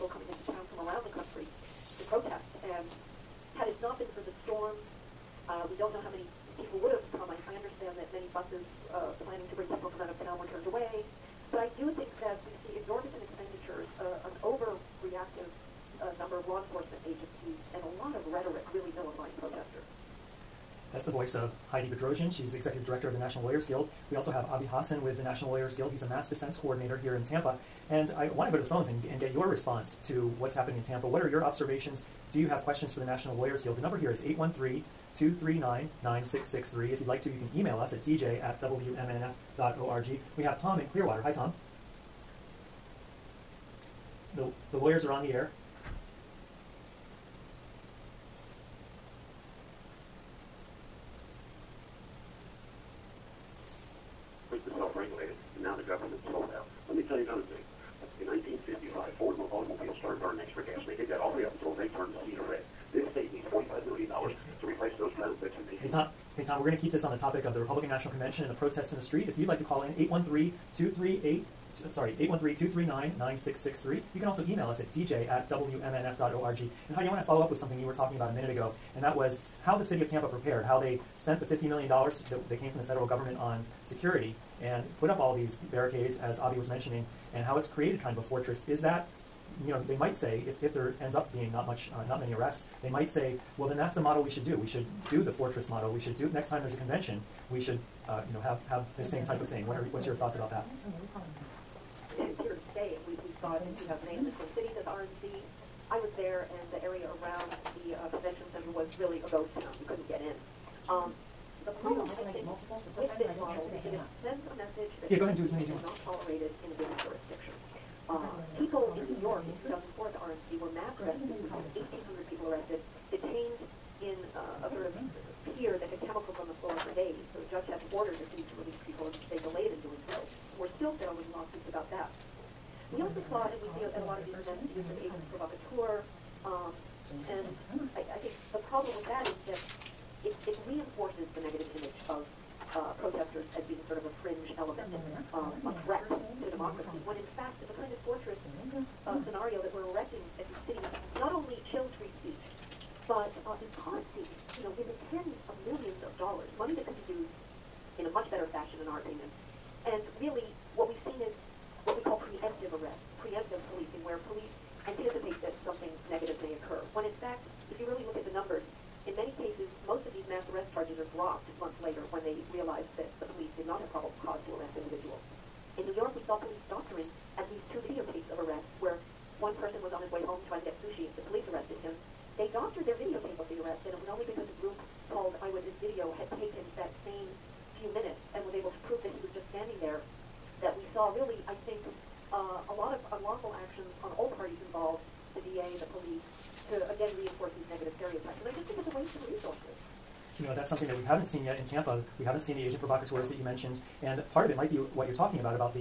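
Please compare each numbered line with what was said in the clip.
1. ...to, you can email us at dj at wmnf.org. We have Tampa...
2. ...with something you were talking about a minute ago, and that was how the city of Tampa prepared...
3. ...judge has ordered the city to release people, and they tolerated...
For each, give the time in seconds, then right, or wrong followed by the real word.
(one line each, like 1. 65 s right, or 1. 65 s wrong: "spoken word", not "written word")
1. 37 s wrong: "Tom", not "Tampa"
2. 77 s right
3. 127 s wrong: "delayed", not "tolerated".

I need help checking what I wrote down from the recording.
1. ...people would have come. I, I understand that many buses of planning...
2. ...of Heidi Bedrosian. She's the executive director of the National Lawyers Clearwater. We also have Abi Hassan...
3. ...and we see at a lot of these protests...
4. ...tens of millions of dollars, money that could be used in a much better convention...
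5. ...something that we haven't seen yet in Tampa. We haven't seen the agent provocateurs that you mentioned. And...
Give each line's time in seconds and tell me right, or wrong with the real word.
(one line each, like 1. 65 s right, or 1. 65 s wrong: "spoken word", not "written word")
1. 6 s right
2. 21 s wrong: "Guild", not "Clearwater"
3. 133 s wrong: "events", not "protests"
4. 155 s wrong: "fashion", not "convention"
5. 200 s right.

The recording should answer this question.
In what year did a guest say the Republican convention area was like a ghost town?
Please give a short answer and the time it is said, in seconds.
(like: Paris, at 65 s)
2008, at 103 s.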